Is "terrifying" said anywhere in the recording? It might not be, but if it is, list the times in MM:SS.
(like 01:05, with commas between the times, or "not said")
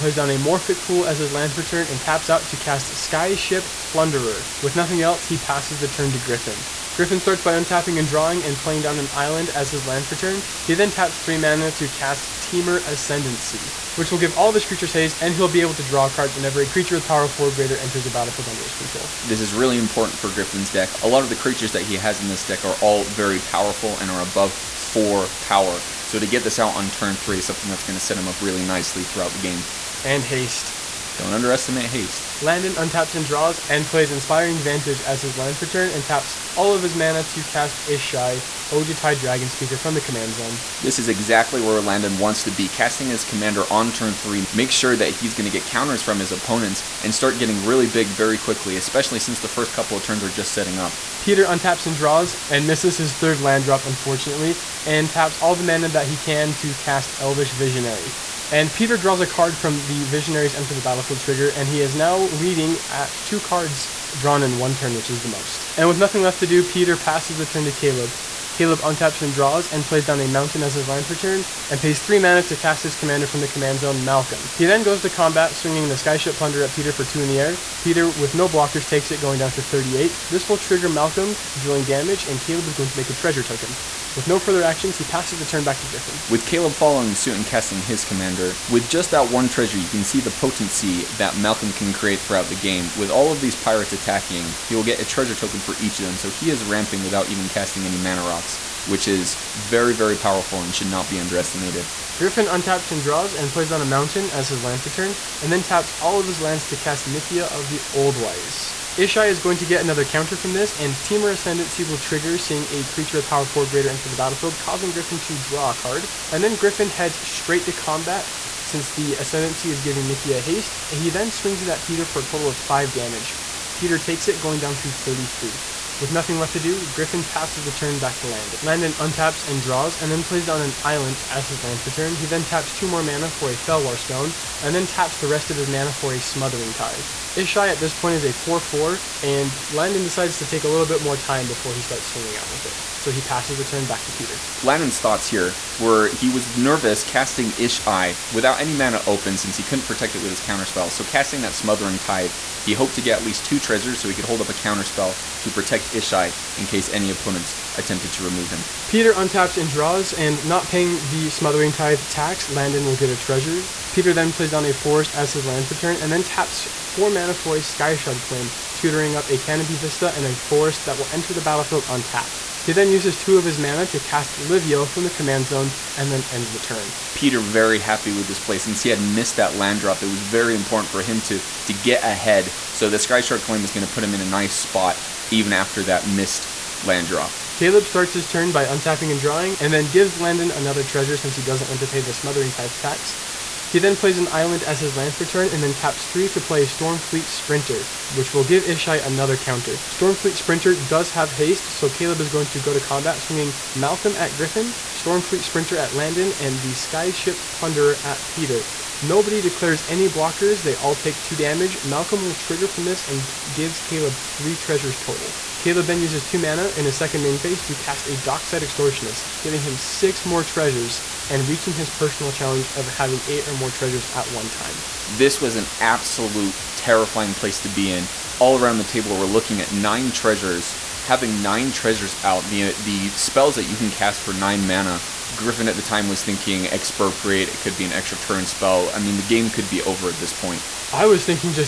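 03:46.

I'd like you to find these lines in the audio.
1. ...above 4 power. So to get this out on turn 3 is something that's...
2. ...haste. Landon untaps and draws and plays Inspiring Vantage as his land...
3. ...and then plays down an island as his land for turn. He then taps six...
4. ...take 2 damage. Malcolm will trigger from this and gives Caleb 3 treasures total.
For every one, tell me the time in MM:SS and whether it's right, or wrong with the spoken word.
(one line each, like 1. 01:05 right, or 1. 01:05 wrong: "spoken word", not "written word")
1. 00:24 right
2. 00:31 right
3. 02:09 wrong: "two", not "six"
4. 03:30 right.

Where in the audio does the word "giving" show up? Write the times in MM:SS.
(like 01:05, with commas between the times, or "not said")
01:59, 03:39.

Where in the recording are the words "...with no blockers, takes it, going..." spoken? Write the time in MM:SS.
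01:18.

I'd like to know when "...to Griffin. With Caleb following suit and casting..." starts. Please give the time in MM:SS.
01:25.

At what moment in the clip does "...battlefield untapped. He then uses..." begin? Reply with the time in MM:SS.
02:51.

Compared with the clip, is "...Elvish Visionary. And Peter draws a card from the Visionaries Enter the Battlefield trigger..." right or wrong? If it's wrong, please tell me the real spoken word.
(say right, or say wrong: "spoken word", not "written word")
right.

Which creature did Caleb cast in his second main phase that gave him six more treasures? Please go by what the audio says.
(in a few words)
Dockside Extortionist.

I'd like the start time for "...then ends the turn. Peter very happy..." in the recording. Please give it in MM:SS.
02:56.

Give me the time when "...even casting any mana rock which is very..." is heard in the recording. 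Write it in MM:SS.
01:37.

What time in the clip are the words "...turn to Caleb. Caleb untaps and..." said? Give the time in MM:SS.
01:07.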